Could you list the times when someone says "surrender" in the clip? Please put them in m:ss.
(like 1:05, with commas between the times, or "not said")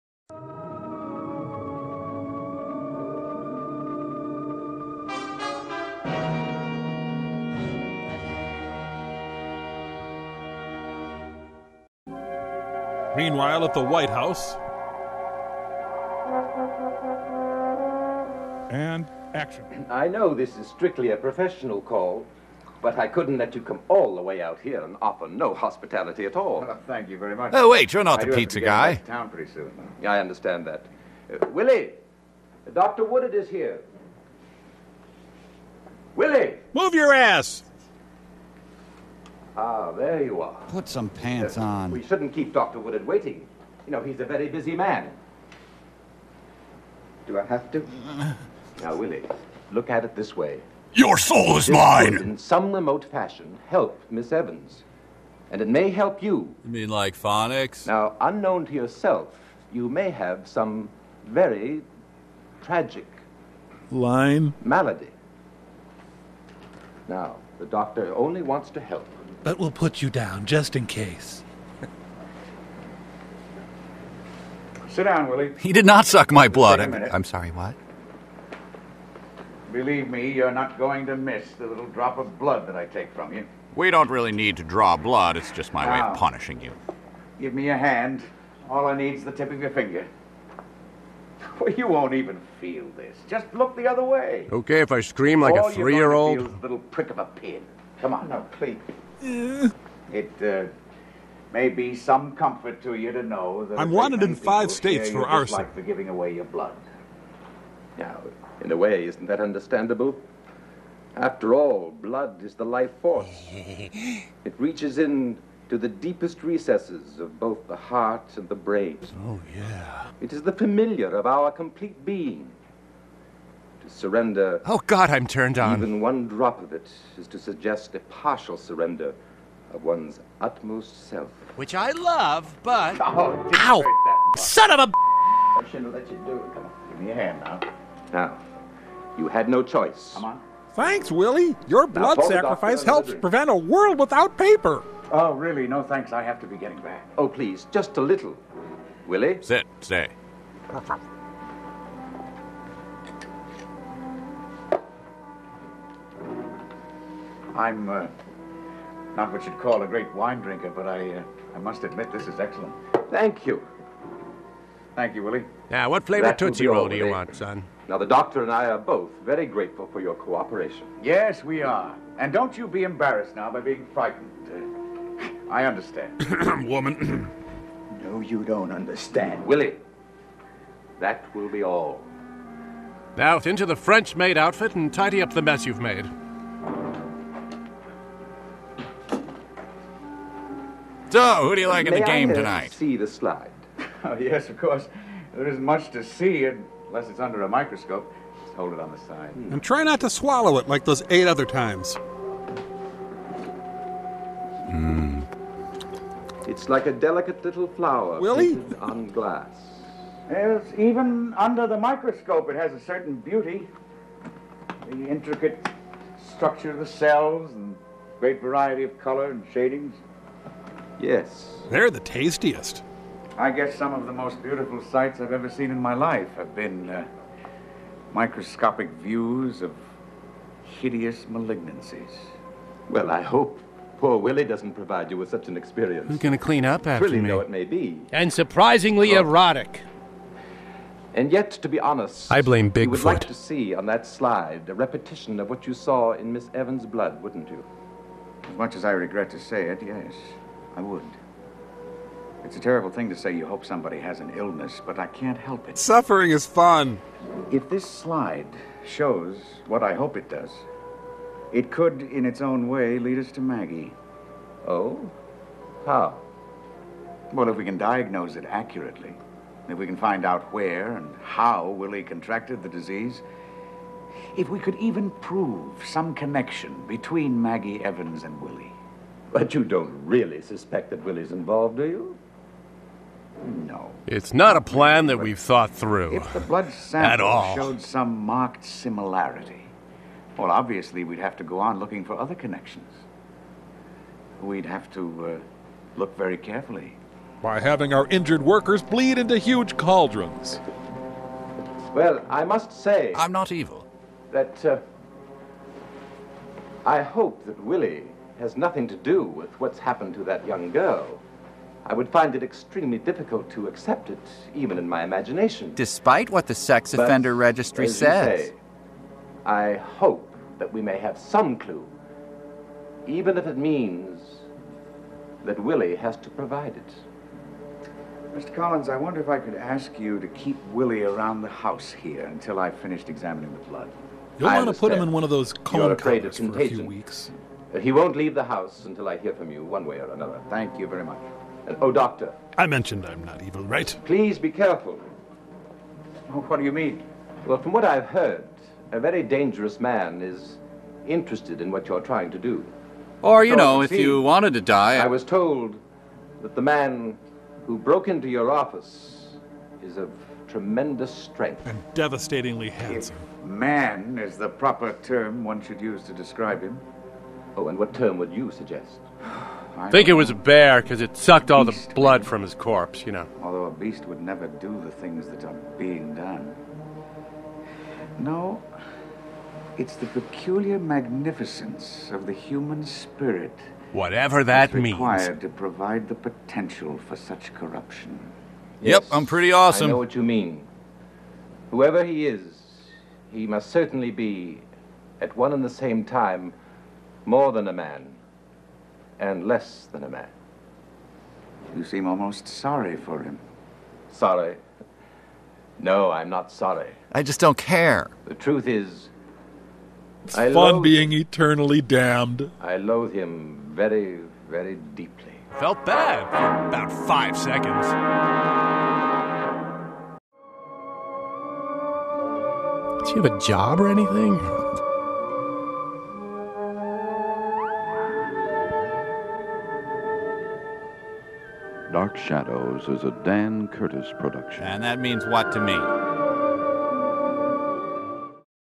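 2:03, 2:08.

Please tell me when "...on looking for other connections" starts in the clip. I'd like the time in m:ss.
4:51.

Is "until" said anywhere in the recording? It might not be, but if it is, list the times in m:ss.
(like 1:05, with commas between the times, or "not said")
5:32, 5:38.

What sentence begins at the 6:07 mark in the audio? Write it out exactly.
Oh, and what term would you suggest?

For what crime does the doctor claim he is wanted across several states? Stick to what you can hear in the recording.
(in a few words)
arson.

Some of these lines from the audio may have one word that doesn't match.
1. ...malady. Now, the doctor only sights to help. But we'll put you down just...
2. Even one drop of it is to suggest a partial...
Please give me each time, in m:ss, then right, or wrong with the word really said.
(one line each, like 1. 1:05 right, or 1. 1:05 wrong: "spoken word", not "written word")
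1. 1:04 wrong: "wants", not "sights"
2. 2:05 right.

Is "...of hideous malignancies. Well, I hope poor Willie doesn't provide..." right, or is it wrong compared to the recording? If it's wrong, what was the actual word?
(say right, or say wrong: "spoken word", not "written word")
right.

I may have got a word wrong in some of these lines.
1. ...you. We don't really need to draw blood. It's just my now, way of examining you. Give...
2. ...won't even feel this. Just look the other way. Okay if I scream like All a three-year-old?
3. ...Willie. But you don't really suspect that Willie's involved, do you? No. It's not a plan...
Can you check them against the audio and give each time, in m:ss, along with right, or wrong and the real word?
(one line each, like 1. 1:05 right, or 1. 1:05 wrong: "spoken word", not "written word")
1. 1:23 wrong: "punishing", not "examining"
2. 1:31 right
3. 4:38 right.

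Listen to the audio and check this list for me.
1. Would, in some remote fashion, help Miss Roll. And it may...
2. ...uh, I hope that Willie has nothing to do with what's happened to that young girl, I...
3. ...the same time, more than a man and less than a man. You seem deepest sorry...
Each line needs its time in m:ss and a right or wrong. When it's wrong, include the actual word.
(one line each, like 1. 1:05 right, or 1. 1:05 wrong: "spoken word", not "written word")
1. 0:52 wrong: "Evans", not "Roll"
2. 5:04 right
3. 6:35 wrong: "almost", not "deepest".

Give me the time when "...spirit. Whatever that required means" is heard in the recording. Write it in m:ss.
6:22.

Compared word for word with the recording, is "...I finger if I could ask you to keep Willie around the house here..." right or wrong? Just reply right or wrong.
wrong.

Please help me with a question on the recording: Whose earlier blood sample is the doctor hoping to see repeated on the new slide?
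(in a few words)
Miss Evans.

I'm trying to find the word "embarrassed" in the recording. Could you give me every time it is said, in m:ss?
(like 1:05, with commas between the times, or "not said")
2:52.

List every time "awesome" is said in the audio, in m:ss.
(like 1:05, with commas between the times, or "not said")
6:29.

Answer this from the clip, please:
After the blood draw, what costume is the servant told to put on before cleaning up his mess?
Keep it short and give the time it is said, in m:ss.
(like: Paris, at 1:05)
French maid outfit, at 3:03.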